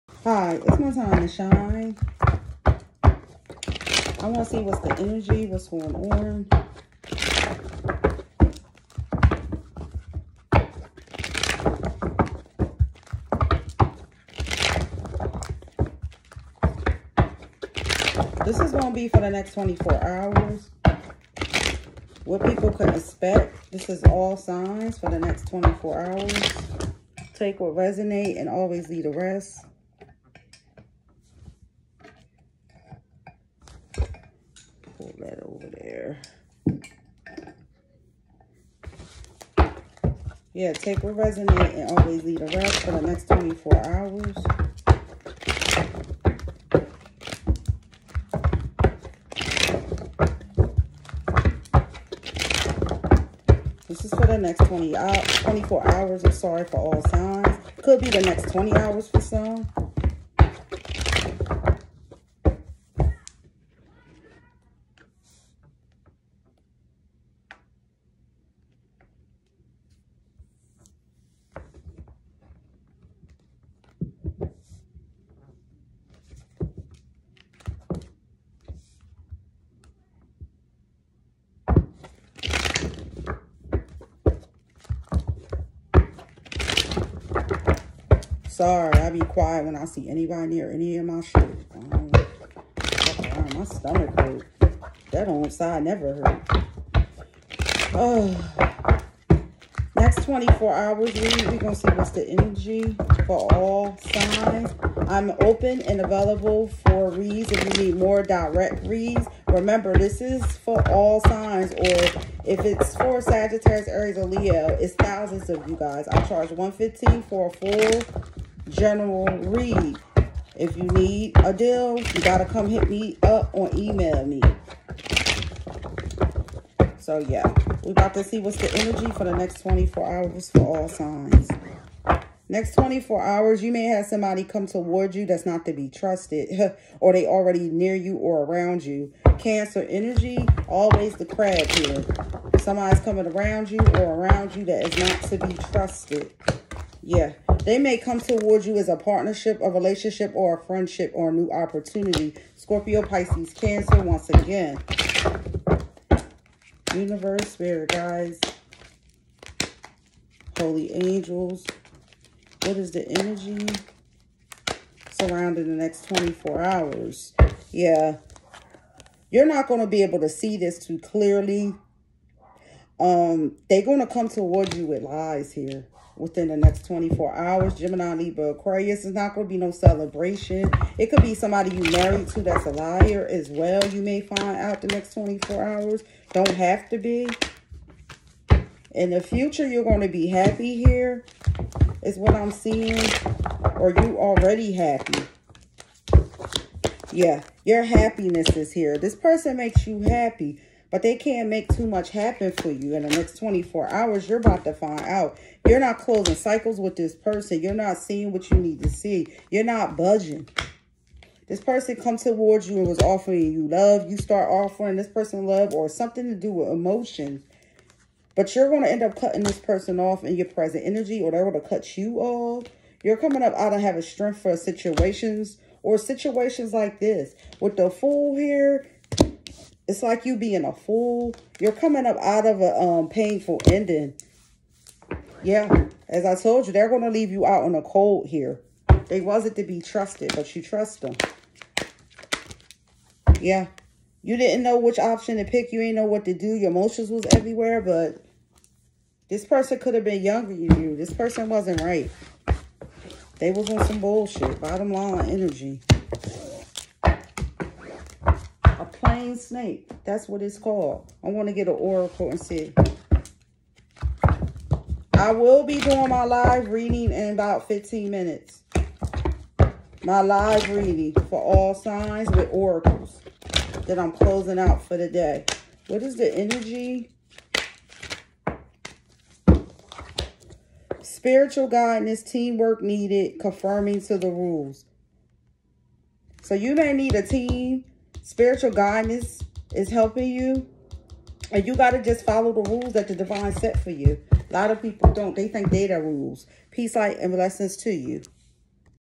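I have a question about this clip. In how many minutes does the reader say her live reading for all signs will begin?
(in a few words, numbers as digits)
15.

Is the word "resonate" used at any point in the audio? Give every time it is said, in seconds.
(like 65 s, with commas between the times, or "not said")
27 s, 41 s.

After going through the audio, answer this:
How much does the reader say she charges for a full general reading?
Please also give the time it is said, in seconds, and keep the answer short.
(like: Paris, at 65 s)
115, at 116 s.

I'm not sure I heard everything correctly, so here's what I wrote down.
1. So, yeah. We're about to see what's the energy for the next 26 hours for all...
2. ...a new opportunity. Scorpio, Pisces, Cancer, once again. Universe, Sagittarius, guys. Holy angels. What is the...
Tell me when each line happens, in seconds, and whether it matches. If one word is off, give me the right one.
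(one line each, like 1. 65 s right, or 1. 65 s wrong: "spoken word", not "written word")
1. 126 s wrong: "24", not "26"
2. 151 s wrong: "Spirit", not "Sagittarius".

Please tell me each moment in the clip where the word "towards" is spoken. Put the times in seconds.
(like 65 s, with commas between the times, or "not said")
134 s, 148 s, 174 s, 212 s.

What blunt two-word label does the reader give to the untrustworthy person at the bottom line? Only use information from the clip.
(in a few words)
plain snake.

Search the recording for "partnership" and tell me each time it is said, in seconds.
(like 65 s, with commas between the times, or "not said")
148 s.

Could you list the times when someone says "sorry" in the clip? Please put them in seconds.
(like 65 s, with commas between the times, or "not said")
56 s, 88 s.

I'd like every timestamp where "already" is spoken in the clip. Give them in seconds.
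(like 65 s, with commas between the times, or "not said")
137 s, 194 s.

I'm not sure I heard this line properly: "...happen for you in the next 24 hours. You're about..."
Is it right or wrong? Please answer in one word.
right.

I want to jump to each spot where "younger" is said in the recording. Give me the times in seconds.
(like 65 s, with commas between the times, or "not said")
250 s.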